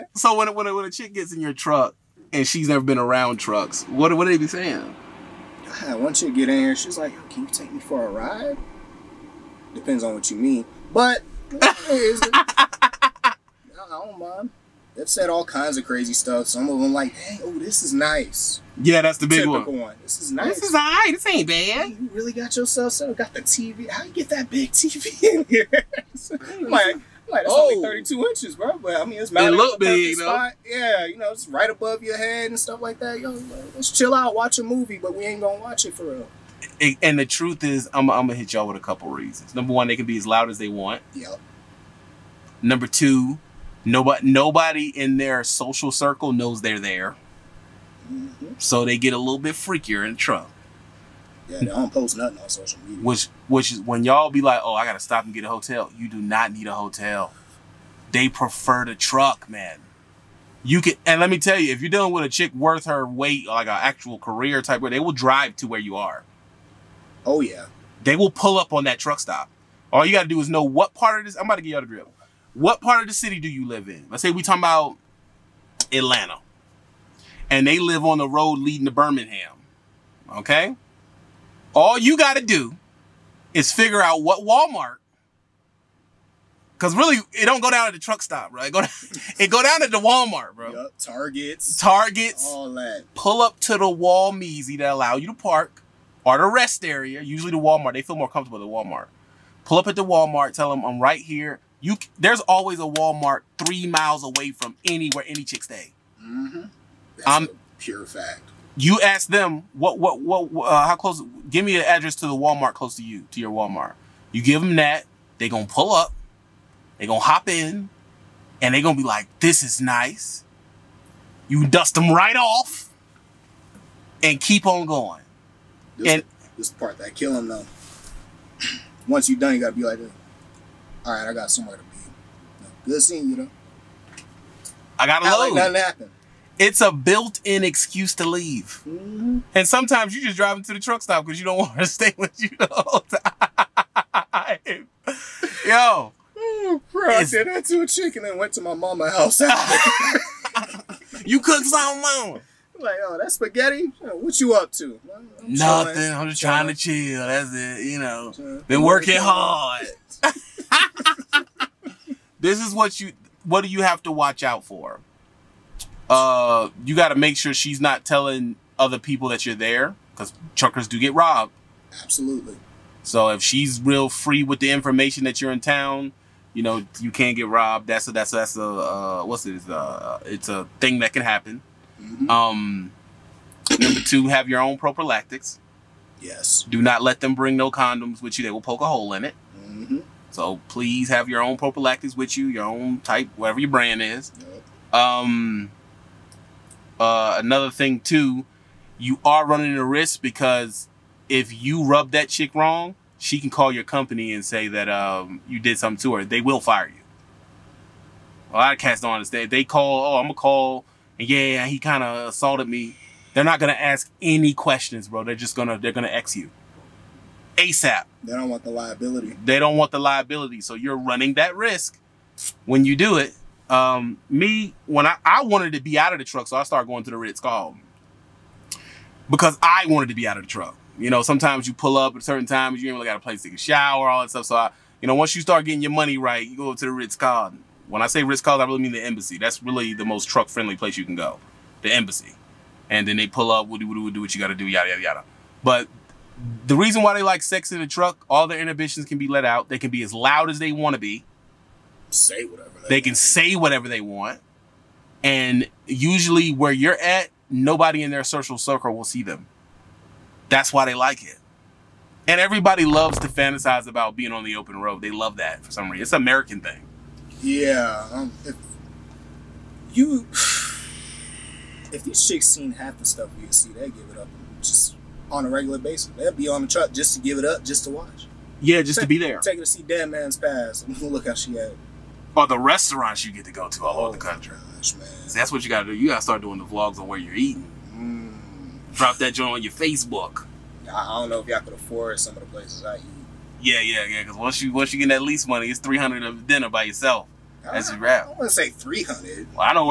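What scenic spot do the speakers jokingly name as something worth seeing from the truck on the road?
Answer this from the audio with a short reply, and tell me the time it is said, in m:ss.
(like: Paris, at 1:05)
Dead Man's Pass, at 4:39.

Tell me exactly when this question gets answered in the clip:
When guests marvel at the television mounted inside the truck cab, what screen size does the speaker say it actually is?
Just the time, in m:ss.
0:27.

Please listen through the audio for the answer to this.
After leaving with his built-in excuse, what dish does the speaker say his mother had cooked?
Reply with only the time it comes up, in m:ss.
2:33.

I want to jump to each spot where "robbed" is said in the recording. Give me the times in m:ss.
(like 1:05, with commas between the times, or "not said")
2:51, 2:57.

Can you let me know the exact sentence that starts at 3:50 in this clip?
You know, sometimes you pull up at certain times, you ain't really got a place to shower, all that stuff.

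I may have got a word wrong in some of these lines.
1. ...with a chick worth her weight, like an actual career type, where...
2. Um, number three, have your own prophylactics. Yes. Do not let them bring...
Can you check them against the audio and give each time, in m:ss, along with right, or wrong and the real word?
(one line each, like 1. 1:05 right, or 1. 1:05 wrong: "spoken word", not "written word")
1. 1:02 right
2. 3:02 wrong: "two", not "three".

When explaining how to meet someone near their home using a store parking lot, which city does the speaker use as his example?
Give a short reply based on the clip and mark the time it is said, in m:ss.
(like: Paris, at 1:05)
Atlanta, at 1:15.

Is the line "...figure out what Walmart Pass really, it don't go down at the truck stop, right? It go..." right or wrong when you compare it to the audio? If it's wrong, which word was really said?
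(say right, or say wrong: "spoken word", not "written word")
wrong: "Cause", not "Pass".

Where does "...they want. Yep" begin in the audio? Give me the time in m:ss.
0:40.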